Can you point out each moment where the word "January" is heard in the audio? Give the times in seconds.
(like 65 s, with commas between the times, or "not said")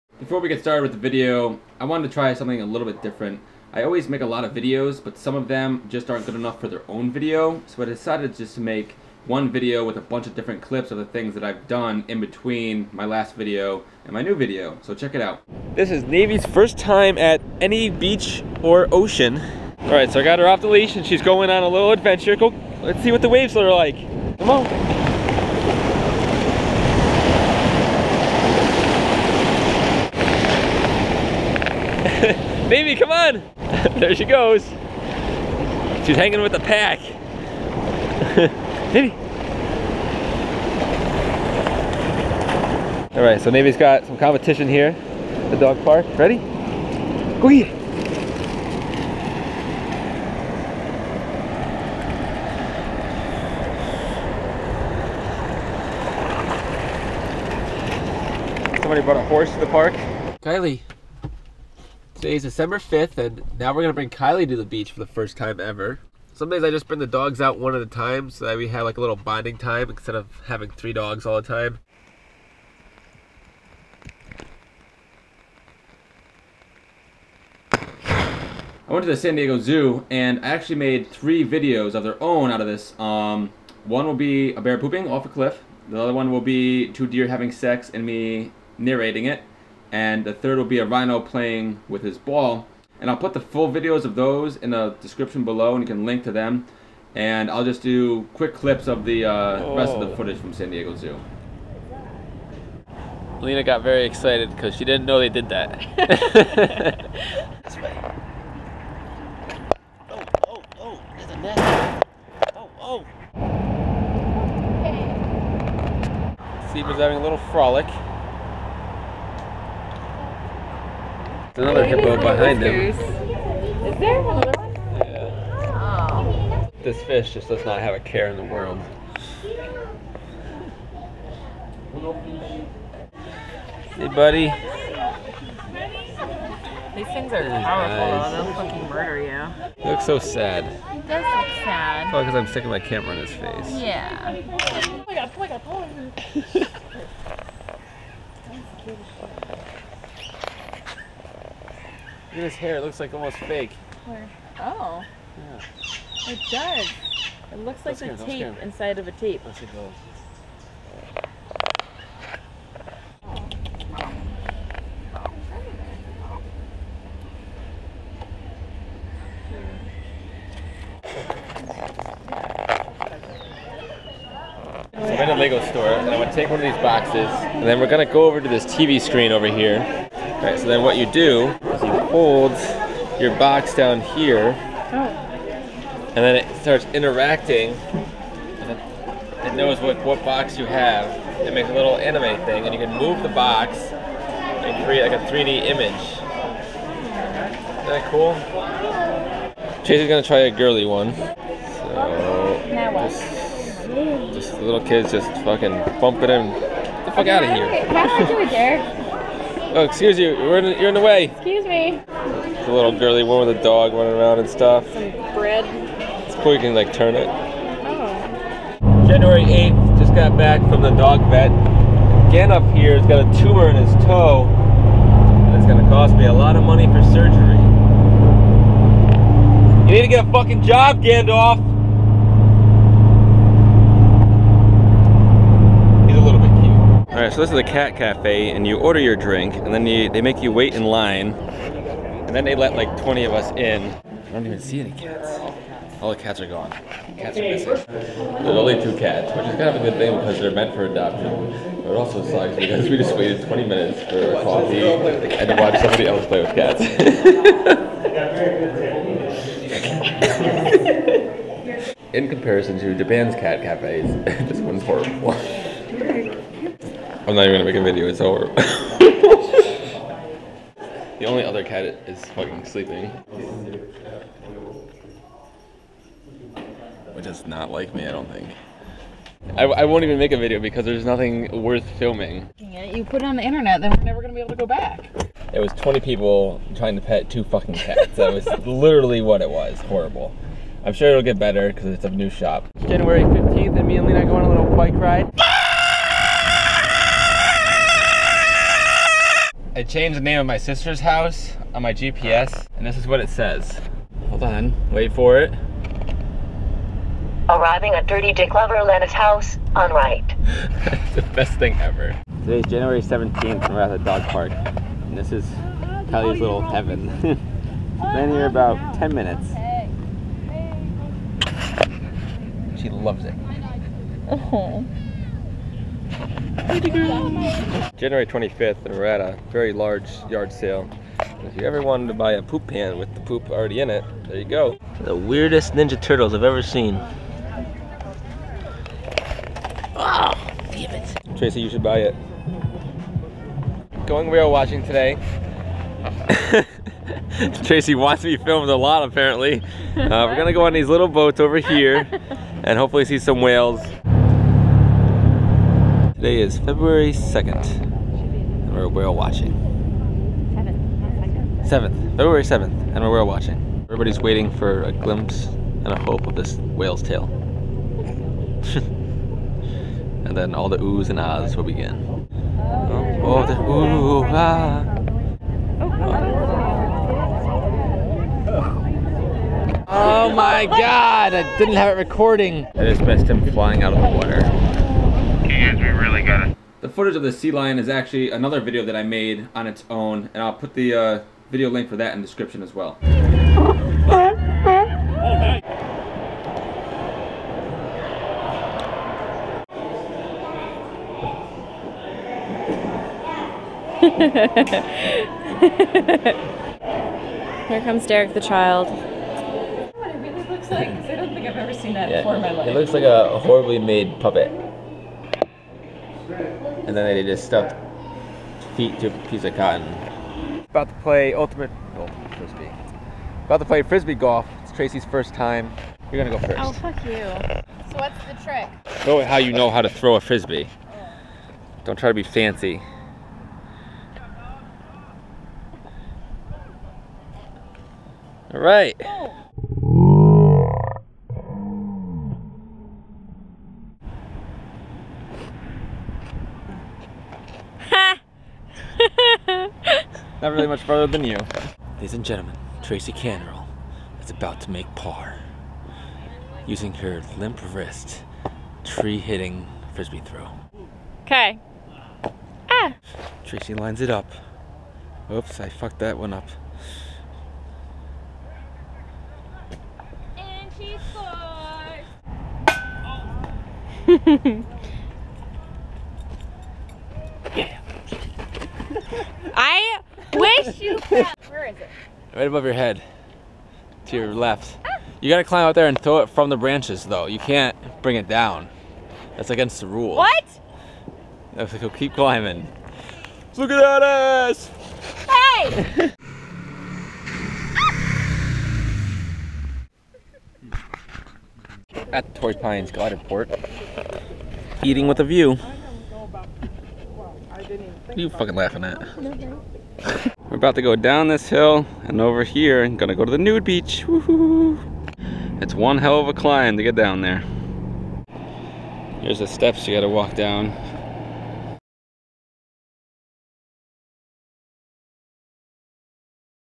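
219 s, 292 s, 312 s, 327 s.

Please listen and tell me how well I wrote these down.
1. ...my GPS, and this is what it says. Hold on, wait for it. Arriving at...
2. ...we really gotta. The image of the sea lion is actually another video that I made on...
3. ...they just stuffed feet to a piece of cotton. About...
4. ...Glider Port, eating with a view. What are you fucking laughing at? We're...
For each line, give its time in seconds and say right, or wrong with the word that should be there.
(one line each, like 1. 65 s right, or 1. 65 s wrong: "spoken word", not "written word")
1. 301 s right
2. 385 s wrong: "footage", not "image"
3. 417 s right
4. 502 s right.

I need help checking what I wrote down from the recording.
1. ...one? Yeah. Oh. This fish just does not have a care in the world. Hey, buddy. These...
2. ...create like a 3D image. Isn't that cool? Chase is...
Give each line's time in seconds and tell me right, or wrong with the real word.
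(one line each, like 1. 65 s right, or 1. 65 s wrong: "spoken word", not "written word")
1. 124 s right
2. 194 s right.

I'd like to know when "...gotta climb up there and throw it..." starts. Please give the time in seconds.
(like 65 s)
485 s.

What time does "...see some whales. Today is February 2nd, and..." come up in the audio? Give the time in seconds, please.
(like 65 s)
353 s.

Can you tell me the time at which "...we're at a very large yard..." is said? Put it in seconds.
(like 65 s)
328 s.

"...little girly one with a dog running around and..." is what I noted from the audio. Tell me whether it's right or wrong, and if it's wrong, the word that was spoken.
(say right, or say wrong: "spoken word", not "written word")
right.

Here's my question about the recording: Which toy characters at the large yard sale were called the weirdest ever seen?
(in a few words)
Ninja Turtles.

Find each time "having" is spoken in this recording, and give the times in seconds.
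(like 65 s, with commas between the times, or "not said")
70 s, 87 s, 116 s.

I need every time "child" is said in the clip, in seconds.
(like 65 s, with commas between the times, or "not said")
408 s.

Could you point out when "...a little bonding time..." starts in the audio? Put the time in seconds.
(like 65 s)
68 s.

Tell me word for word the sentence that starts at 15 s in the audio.
This is Navy's first time at any beach or ocean.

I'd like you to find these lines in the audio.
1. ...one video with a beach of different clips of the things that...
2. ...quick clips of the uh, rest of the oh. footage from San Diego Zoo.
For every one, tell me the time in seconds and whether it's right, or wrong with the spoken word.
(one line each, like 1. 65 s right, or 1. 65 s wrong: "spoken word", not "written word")
1. 9 s wrong: "bunch", not "beach"
2. 98 s right.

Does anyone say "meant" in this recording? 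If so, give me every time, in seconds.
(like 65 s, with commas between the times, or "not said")
250 s.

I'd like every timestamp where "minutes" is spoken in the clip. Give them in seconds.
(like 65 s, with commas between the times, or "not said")
253 s, 319 s.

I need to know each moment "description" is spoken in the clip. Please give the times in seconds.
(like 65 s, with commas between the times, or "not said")
95 s, 392 s.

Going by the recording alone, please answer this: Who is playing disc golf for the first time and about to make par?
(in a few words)
Tracy Canrell.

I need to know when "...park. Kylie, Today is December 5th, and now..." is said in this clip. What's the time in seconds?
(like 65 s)
59 s.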